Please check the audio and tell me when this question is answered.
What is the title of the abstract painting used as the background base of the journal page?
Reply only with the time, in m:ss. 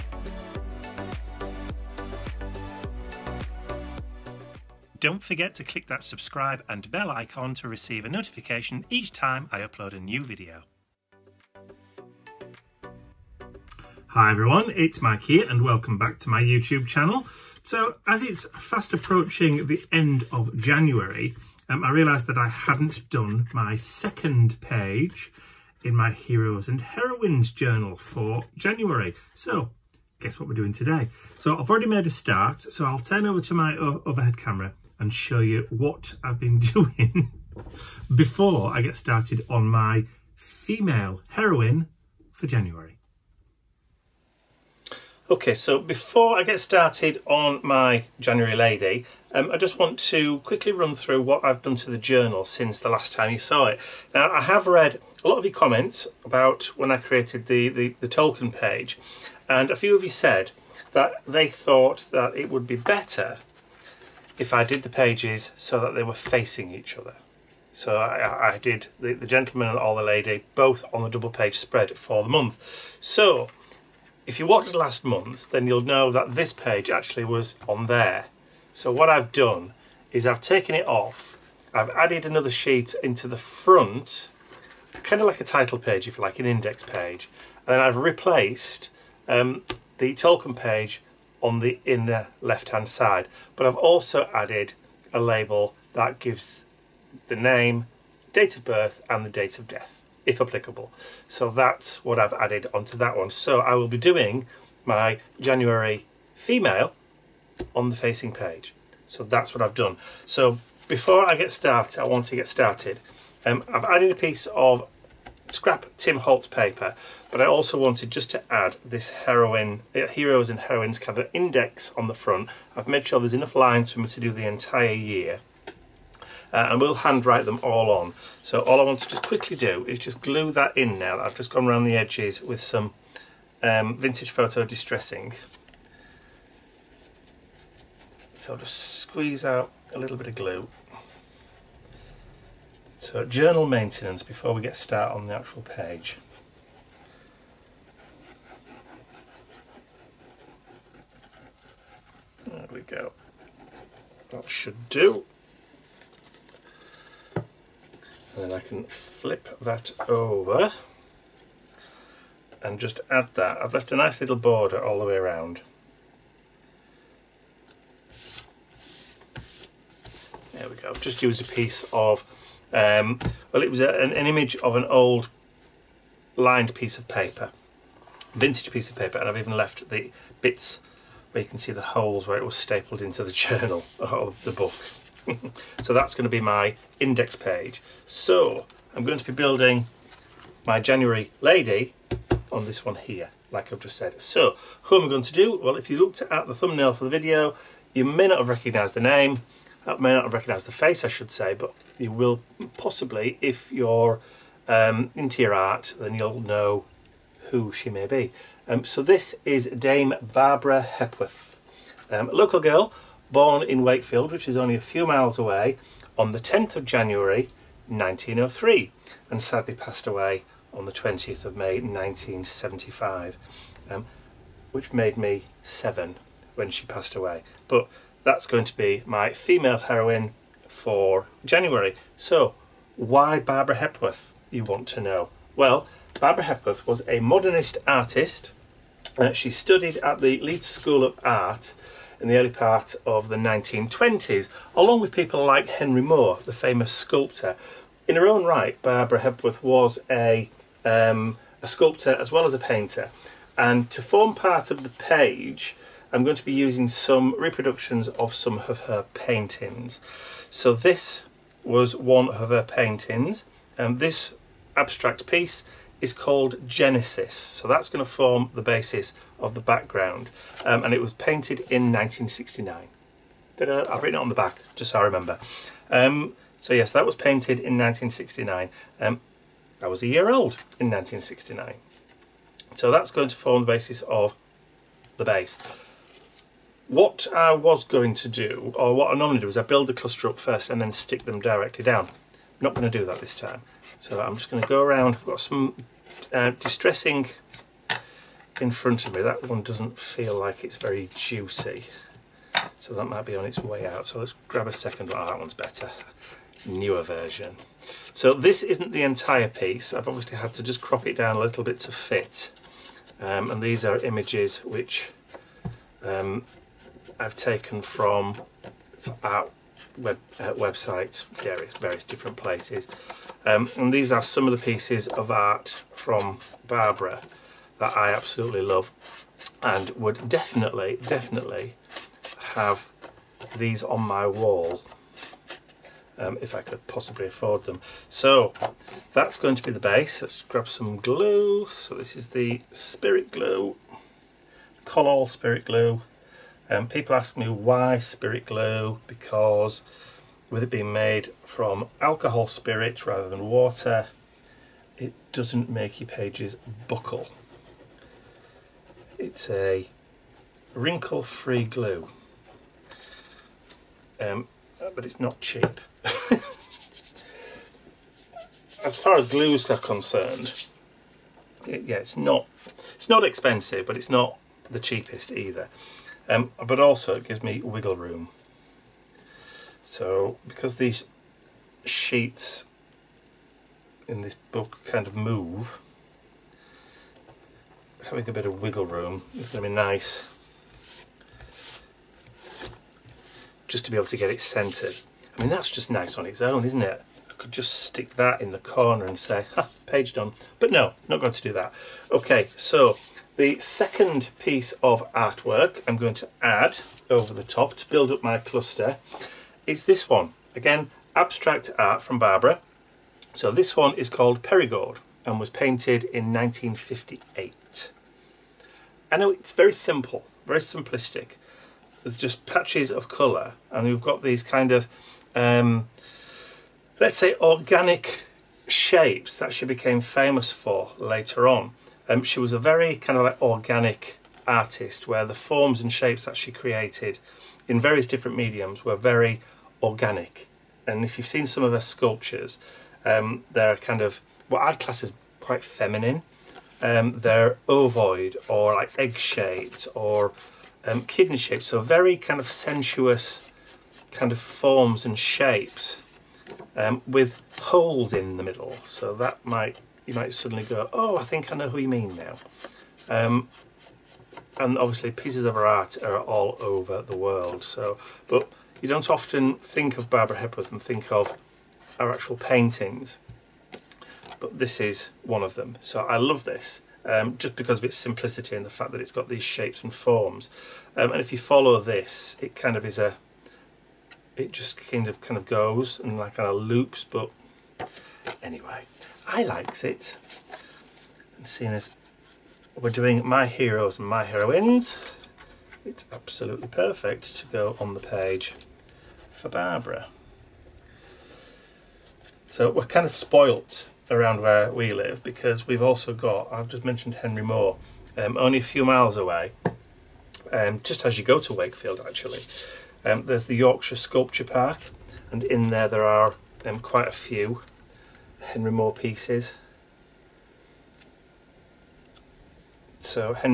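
4:26.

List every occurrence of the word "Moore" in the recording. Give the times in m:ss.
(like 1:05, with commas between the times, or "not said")
4:06, 8:27, 8:38.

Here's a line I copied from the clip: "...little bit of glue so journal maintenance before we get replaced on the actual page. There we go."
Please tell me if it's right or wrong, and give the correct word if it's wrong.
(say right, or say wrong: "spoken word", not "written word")
wrong: "started", not "replaced".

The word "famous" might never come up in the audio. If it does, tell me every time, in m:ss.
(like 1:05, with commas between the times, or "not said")
4:06, 7:10.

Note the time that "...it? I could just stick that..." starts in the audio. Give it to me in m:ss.
6:36.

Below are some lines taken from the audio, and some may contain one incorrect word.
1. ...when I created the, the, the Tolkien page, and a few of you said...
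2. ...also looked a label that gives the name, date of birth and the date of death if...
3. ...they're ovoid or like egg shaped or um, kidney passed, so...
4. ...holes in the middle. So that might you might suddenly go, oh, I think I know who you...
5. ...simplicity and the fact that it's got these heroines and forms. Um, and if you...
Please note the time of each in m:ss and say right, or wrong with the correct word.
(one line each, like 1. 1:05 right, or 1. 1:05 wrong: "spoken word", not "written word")
1. 0:56 right
2. 1:33 wrong: "added", not "looked"
3. 7:27 wrong: "shaped", not "passed"
4. 7:37 right
5. 7:57 wrong: "shapes", not "heroines".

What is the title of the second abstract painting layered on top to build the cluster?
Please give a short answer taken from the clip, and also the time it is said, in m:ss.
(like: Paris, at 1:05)
Perigord, at 6:54.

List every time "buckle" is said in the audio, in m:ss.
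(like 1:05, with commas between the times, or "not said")
5:56.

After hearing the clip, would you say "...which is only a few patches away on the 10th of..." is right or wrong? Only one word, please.
wrong.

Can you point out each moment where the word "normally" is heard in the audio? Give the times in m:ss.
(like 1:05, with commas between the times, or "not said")
4:49.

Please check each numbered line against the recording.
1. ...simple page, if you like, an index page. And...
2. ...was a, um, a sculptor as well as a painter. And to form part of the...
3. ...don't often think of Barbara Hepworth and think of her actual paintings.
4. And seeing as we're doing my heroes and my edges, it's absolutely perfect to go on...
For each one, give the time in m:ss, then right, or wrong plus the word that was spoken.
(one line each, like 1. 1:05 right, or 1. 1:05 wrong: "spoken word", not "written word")
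1. 1:25 wrong: "title", not "simple"
2. 4:09 right
3. 7:48 right
4. 8:11 wrong: "heroines", not "edges".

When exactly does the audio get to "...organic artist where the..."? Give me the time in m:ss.
7:13.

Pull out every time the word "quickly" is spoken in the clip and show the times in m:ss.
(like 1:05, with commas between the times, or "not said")
0:50, 2:09.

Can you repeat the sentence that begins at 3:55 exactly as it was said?
Well, Barbara Hepworth was a modernist artist.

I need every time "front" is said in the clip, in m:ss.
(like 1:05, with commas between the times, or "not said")
1:23, 2:02, 4:58.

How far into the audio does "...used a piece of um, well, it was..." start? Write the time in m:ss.
2:51.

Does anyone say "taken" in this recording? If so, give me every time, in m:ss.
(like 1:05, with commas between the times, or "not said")
1:20, 5:17.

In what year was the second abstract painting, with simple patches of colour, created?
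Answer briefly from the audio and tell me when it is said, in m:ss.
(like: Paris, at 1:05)
1958, at 6:56.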